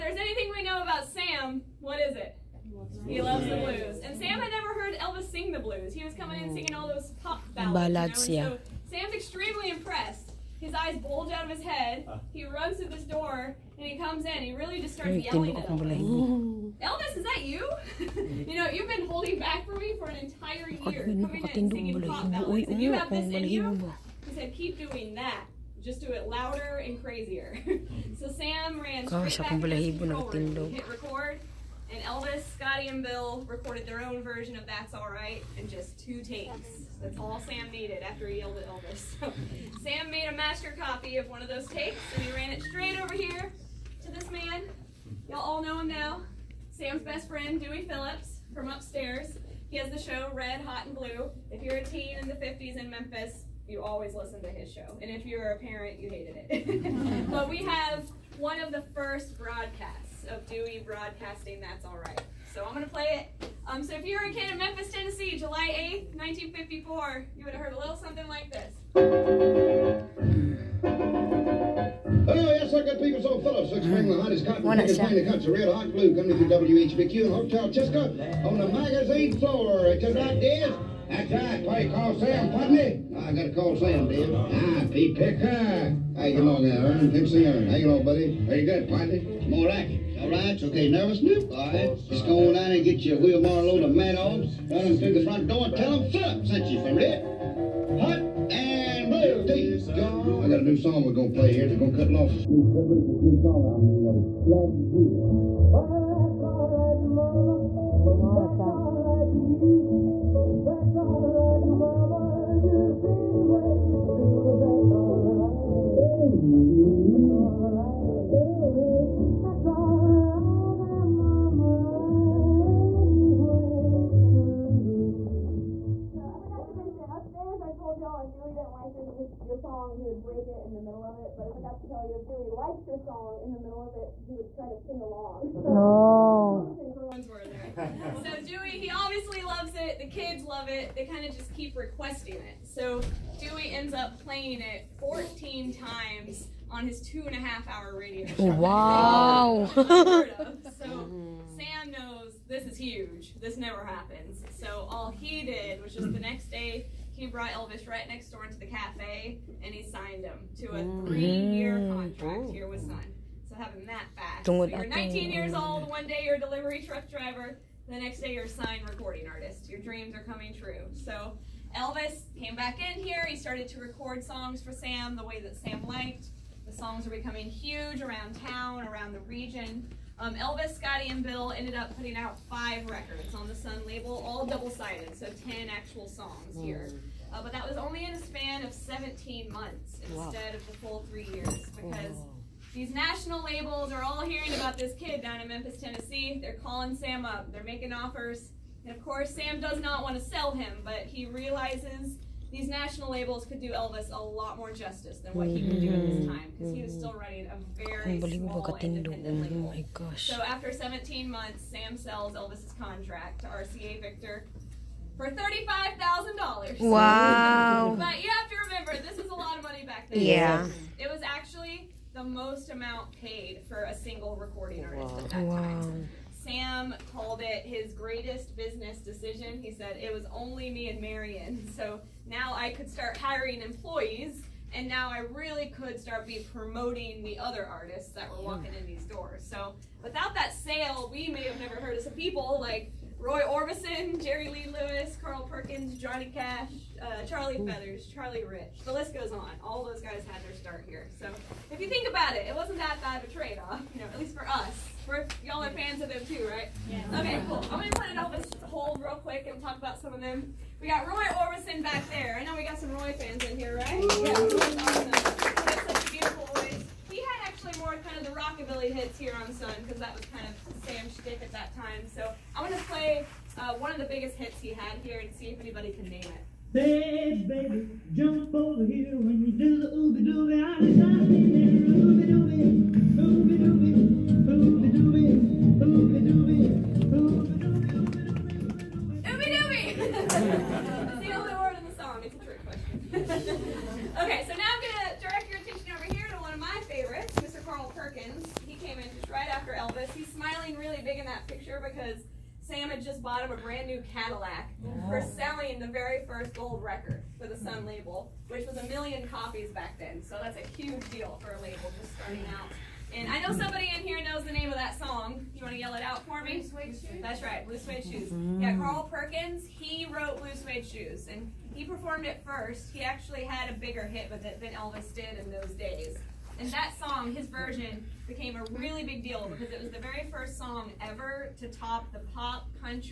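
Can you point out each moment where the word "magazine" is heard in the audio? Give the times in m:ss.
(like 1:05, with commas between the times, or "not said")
1:18.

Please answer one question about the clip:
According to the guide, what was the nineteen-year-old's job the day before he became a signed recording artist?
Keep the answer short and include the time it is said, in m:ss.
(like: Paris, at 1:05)
Delivery truck driver, at 2:46.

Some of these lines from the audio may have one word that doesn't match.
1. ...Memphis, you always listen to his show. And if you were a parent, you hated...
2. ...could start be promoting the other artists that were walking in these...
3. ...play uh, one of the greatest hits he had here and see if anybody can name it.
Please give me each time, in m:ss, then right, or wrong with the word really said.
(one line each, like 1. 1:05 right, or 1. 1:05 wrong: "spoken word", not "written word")
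1. 0:52 right
2. 3:55 right
3. 4:32 wrong: "biggest", not "greatest".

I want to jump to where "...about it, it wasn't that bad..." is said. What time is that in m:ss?
4:12.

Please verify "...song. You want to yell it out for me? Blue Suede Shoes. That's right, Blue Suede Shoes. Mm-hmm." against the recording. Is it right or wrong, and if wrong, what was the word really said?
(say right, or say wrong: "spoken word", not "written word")
right.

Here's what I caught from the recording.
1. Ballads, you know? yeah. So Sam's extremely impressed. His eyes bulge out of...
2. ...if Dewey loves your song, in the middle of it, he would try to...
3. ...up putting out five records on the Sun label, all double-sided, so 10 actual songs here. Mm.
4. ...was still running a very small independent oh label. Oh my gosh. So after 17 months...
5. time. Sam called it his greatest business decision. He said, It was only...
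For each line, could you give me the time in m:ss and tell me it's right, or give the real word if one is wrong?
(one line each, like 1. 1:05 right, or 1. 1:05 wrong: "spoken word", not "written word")
1. 0:07 right
2. 2:12 wrong: "likes", not "loves"
3. 3:01 right
4. 3:26 right
5. 3:45 right.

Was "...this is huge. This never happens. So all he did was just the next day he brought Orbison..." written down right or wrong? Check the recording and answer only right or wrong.
wrong.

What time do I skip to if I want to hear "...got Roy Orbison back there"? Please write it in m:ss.
4:20.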